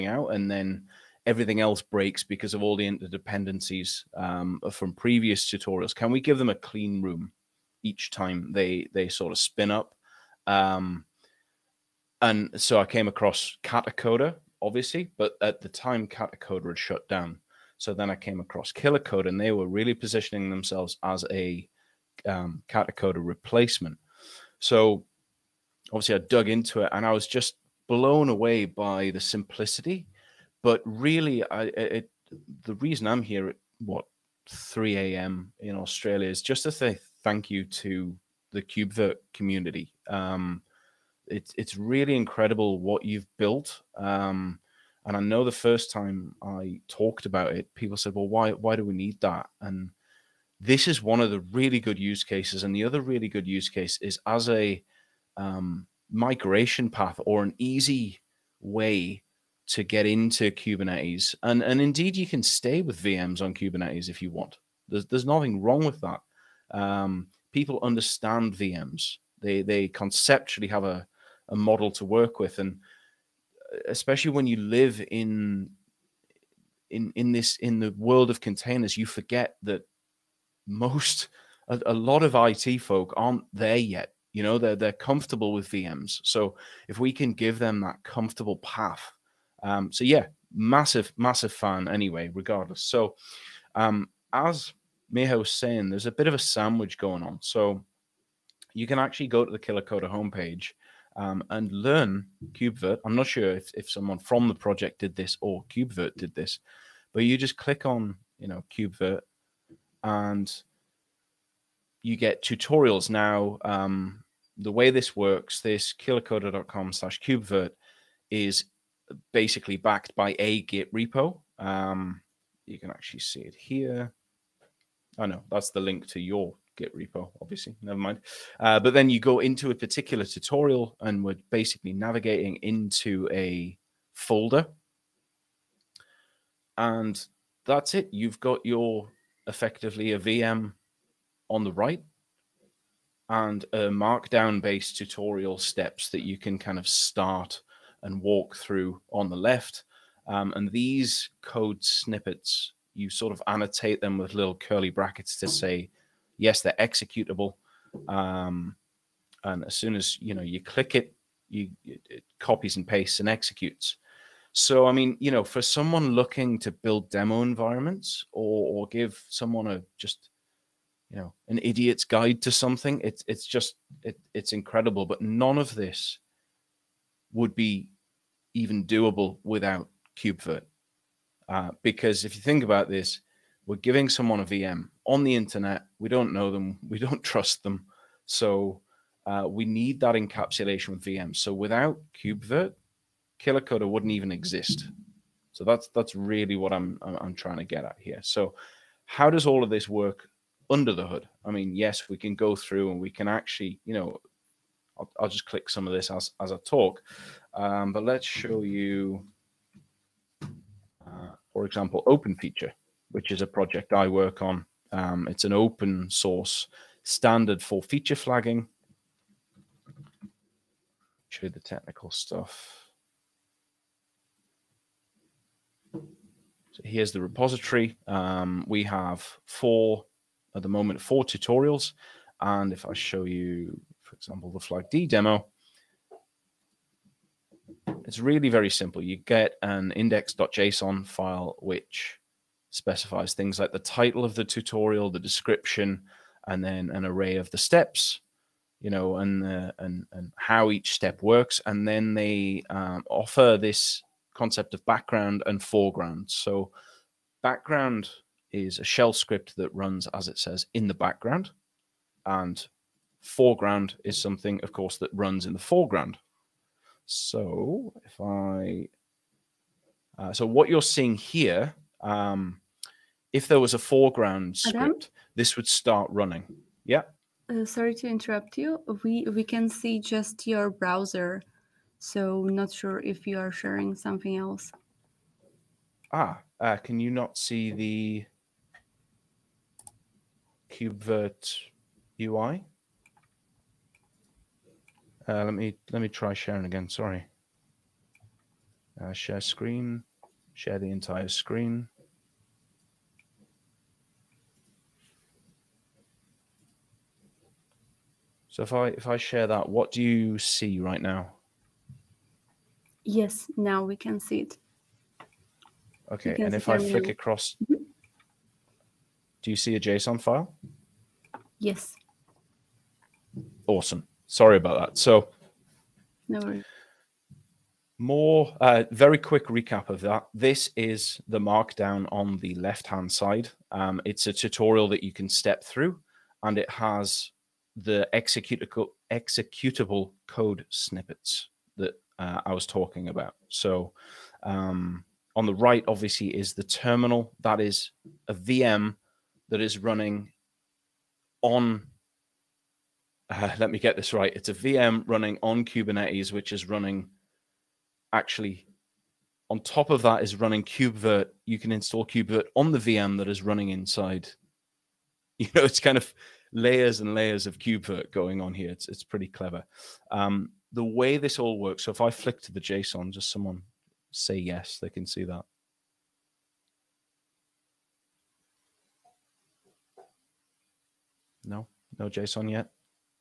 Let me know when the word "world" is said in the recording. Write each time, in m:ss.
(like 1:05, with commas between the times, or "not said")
1:17.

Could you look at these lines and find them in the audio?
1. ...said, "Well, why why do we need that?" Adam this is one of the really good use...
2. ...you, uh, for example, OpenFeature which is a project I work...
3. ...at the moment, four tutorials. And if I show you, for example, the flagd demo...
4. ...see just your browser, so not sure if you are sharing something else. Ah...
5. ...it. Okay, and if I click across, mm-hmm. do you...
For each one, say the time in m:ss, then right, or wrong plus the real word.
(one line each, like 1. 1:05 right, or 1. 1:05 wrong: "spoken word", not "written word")
1. 0:47 wrong: "And", not "Adam"
2. 3:28 right
3. 3:50 right
4. 4:39 right
5. 5:14 wrong: "flick", not "click".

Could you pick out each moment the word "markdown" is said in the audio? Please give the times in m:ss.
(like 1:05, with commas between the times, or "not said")
2:23, 5:31.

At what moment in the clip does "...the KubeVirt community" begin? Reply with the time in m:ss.
0:38.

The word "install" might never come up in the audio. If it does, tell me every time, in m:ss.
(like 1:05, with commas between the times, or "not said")
6:01.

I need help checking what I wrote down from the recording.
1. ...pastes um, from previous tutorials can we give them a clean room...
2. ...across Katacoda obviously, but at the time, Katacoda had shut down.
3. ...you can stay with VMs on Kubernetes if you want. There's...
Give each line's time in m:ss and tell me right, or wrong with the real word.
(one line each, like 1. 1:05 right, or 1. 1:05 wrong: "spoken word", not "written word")
1. 0:02 wrong: "interdependencies", not "pastes"
2. 0:13 right
3. 1:02 right.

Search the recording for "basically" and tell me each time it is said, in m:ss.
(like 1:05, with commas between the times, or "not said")
1:59, 2:11.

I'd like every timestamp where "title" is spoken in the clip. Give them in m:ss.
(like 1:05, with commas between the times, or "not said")
4:03.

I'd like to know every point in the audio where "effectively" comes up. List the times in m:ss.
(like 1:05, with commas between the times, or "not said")
2:19.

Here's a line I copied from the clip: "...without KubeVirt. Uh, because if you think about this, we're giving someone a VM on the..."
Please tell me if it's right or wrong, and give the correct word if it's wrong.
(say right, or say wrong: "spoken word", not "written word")
right.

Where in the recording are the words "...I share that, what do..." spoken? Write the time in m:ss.
5:09.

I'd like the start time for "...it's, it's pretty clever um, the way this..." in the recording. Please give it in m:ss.
6:08.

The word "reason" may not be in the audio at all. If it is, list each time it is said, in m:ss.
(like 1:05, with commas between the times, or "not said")
0:32.